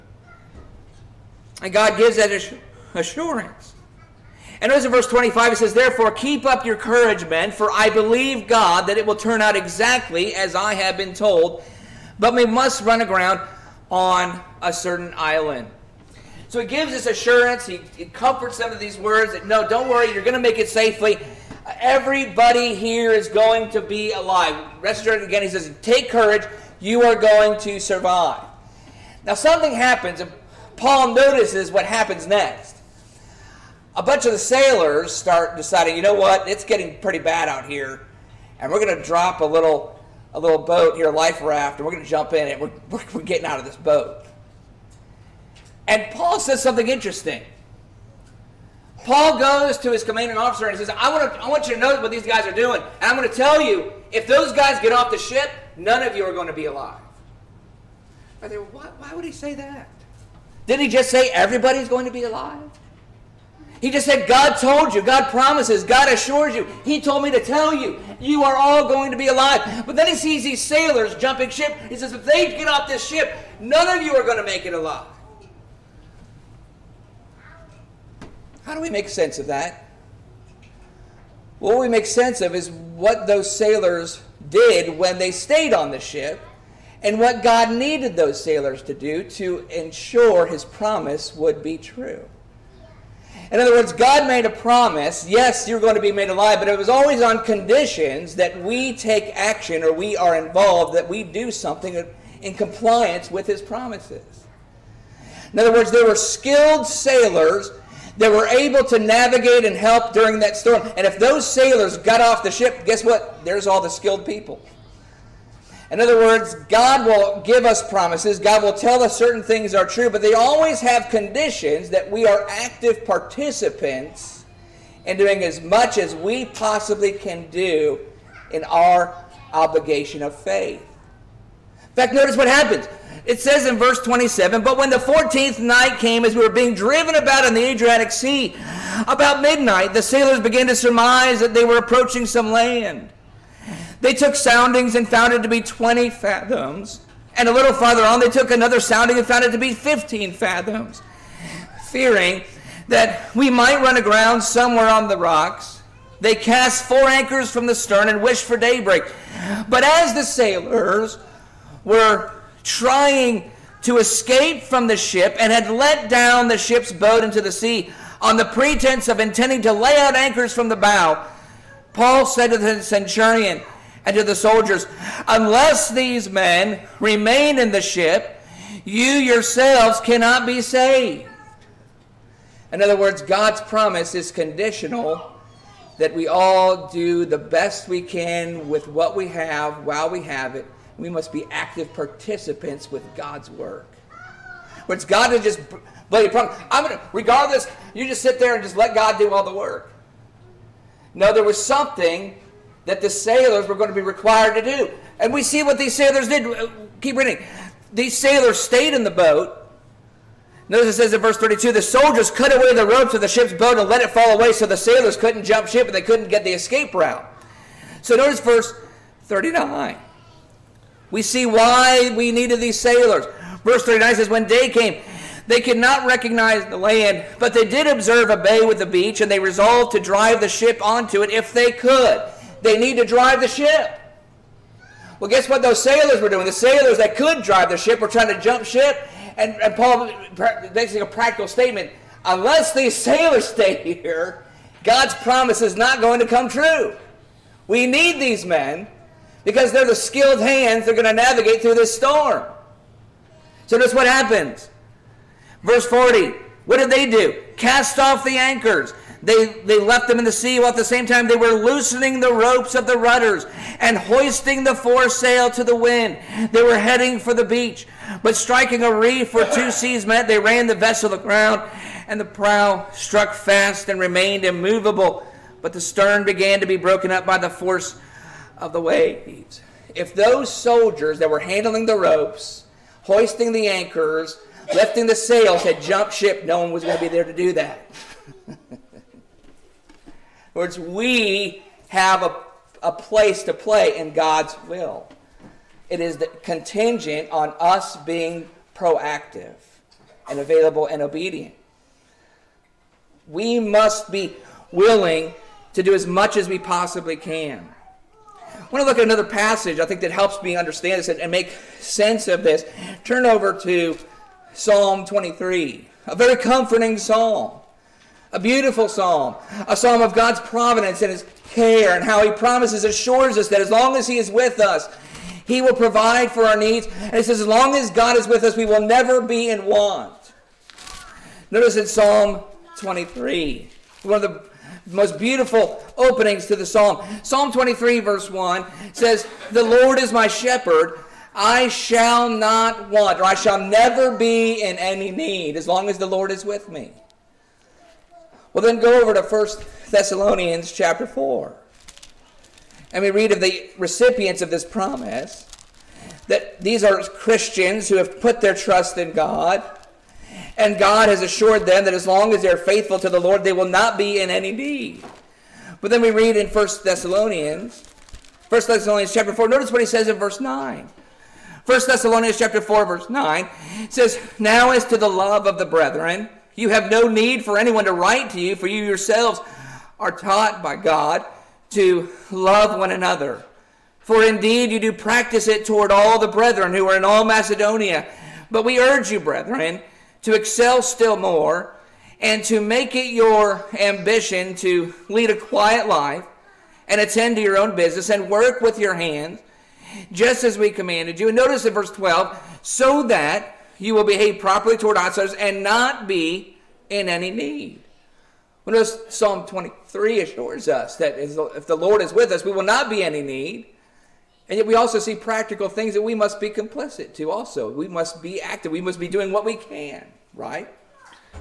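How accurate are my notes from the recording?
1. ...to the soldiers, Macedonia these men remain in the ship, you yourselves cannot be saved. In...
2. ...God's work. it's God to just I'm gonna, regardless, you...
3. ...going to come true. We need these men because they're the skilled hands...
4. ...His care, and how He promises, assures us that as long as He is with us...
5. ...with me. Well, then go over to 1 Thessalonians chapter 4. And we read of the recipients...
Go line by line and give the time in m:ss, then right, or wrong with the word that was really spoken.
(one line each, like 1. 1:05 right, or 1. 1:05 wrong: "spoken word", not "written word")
1. 2:54 wrong: "Unless", not "Macedonia"
2. 3:13 right
3. 4:06 right
4. 5:21 right
5. 5:46 right.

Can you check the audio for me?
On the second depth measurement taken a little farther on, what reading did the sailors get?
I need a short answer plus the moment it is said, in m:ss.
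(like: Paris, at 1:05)
15 fathoms, at 2:29.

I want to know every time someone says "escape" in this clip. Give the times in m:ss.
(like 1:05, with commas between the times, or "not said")
2:43, 3:36.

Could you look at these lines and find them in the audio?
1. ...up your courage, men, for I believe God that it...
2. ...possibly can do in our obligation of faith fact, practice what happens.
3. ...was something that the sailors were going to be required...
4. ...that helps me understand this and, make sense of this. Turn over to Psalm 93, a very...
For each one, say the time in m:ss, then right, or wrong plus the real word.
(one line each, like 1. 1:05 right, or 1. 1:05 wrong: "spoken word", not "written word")
1. 0:06 right
2. 2:06 wrong: "notice", not "practice"
3. 3:21 right
4. 5:10 wrong: "23", not "93".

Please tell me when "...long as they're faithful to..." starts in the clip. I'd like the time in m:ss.
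6:02.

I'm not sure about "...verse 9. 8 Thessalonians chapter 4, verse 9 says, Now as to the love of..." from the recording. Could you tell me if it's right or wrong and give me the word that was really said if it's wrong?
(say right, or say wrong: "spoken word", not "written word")
wrong: "1", not "8".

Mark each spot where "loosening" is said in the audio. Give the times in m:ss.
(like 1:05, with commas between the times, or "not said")
4:21.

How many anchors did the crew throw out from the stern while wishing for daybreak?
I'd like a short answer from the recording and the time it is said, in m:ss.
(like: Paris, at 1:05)
4, at 2:36.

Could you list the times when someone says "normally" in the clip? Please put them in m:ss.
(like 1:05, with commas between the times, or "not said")
not said.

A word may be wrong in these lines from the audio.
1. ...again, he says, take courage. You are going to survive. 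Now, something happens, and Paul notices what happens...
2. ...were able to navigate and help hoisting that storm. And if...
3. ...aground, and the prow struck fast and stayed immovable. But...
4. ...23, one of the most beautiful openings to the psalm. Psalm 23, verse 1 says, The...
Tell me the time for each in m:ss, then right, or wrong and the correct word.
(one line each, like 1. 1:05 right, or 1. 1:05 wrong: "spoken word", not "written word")
1. 0:25 right
2. 1:48 wrong: "during", not "hoisting"
3. 4:31 wrong: "remained", not "stayed"
4. 5:32 right.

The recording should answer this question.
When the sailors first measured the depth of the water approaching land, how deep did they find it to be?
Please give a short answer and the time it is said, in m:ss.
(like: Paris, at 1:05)
20 fathoms, at 2:25.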